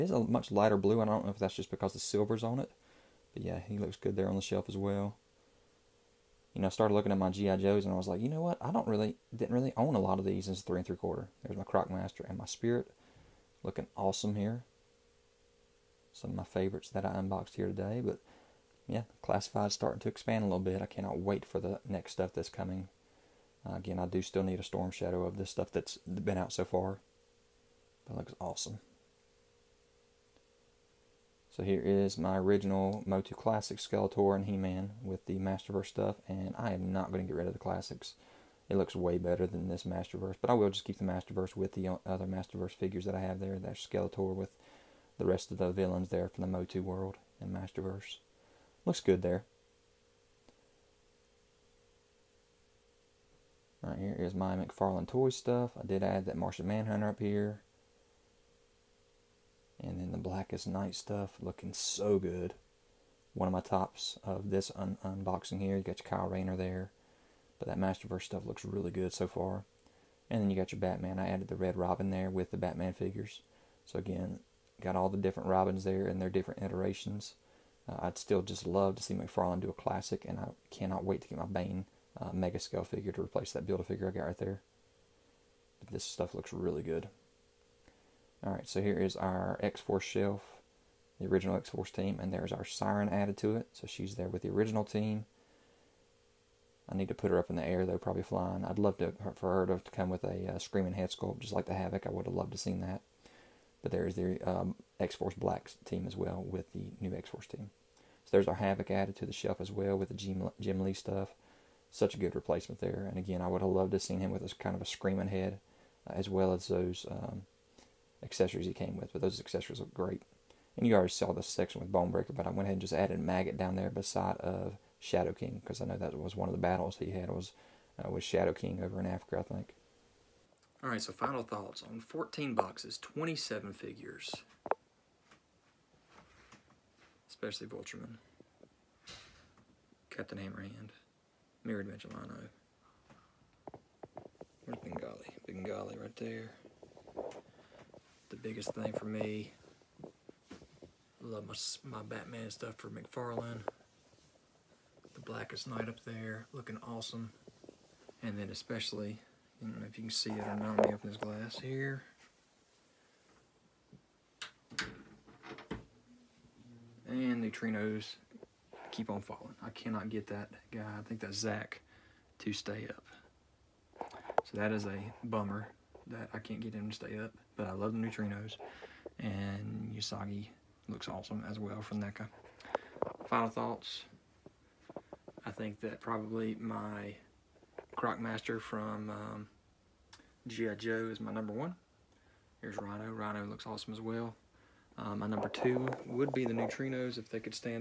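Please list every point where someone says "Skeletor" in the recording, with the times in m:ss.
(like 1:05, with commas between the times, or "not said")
0:33, 0:43.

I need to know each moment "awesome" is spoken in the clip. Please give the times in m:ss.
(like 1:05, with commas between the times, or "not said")
0:13, 0:28, 2:36, 3:01, 3:13.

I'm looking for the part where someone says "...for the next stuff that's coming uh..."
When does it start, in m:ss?
0:21.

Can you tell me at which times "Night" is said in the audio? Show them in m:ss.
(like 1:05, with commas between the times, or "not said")
1:00, 2:35.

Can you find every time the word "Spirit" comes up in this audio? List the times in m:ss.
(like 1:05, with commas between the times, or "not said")
0:12.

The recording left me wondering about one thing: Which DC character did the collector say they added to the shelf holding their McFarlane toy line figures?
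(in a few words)
Martian Manhunter.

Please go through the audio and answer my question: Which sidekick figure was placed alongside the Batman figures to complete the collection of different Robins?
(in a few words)
Red Robin.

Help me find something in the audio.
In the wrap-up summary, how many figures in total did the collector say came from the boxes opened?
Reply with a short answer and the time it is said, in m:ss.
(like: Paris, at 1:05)
27, at 2:12.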